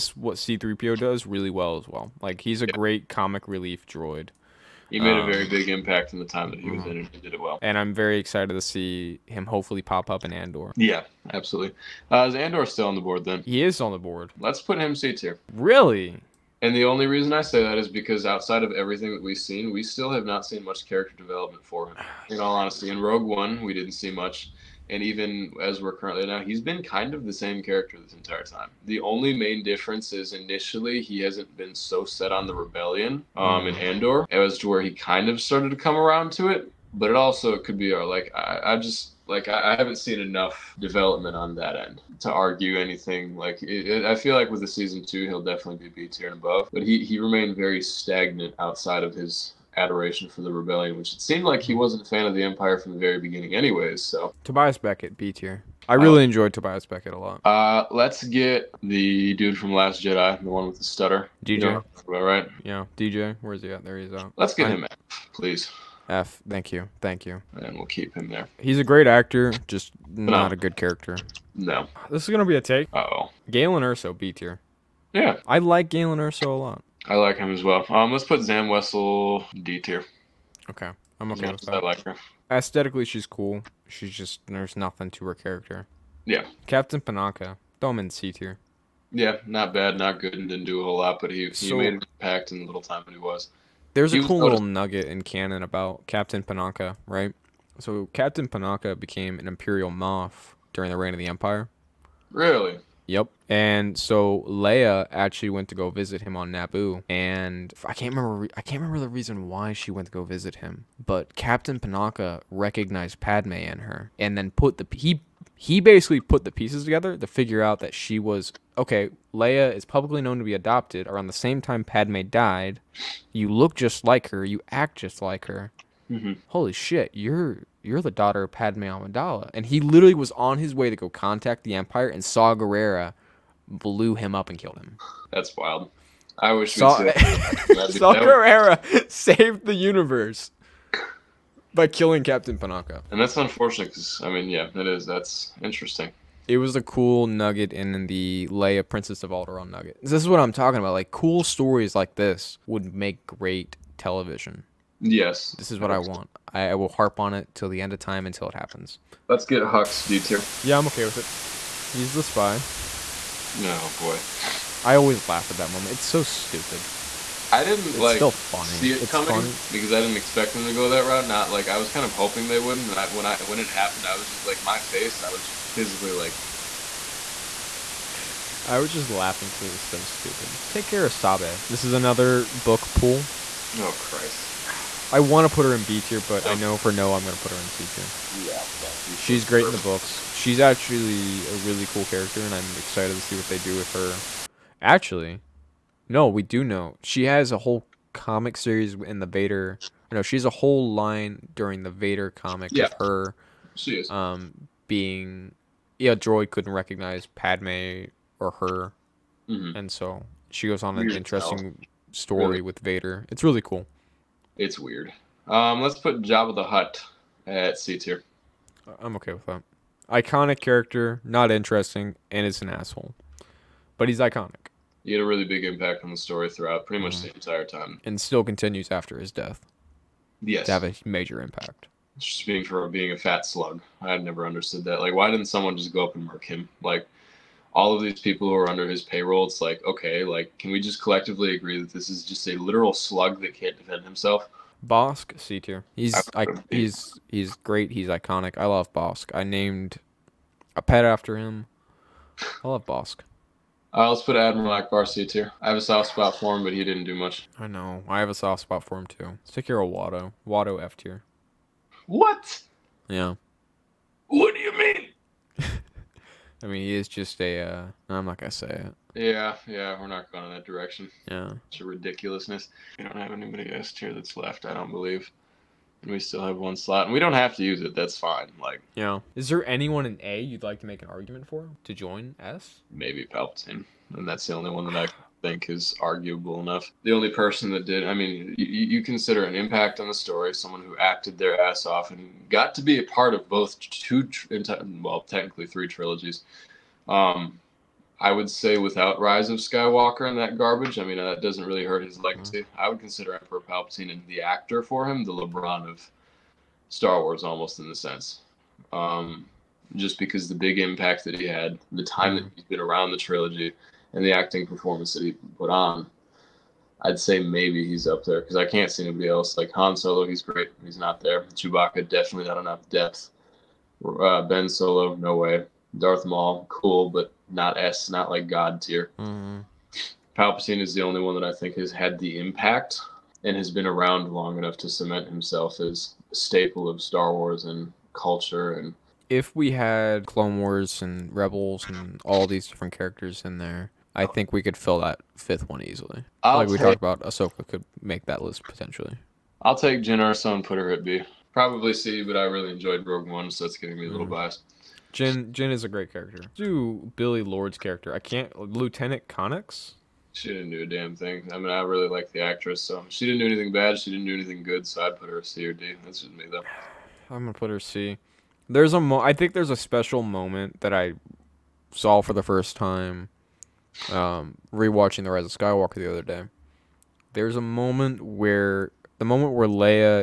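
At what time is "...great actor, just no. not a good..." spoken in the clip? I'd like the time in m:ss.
1:08.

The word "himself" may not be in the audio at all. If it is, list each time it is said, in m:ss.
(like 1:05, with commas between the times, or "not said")
4:04, 5:35.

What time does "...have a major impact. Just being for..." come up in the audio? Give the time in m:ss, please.
3:50.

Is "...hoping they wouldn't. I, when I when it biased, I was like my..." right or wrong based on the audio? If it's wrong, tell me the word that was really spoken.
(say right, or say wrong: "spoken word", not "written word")
wrong: "happened", not "biased".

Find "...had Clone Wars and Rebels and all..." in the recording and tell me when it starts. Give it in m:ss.
5:39.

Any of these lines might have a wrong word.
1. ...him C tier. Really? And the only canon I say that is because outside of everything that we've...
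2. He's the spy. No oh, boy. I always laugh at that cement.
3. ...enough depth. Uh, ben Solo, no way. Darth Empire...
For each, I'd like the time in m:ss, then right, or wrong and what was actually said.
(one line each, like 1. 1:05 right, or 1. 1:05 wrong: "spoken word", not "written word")
1. 0:14 wrong: "reason", not "canon"
2. 2:41 wrong: "moment", not "cement"
3. 5:22 wrong: "Maul", not "Empire".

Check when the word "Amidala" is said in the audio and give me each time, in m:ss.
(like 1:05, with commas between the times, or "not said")
2:08.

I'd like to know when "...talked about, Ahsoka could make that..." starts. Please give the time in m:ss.
5:46.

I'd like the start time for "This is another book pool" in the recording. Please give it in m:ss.
3:01.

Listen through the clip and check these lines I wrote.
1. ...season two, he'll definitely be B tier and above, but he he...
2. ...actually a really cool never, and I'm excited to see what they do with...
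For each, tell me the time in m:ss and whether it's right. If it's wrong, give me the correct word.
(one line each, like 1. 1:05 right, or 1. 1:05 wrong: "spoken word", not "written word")
1. 0:44 right
2. 3:10 wrong: "character", not "never".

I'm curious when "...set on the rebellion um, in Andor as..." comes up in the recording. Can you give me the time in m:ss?
0:32.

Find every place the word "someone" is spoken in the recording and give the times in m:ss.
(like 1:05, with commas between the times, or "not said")
3:55, 4:50.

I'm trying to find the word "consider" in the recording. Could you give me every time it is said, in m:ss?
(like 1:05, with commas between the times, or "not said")
4:49, 5:02.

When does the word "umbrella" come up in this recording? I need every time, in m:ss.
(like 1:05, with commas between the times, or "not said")
not said.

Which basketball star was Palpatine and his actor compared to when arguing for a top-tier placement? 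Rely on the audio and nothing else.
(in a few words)
LeBron.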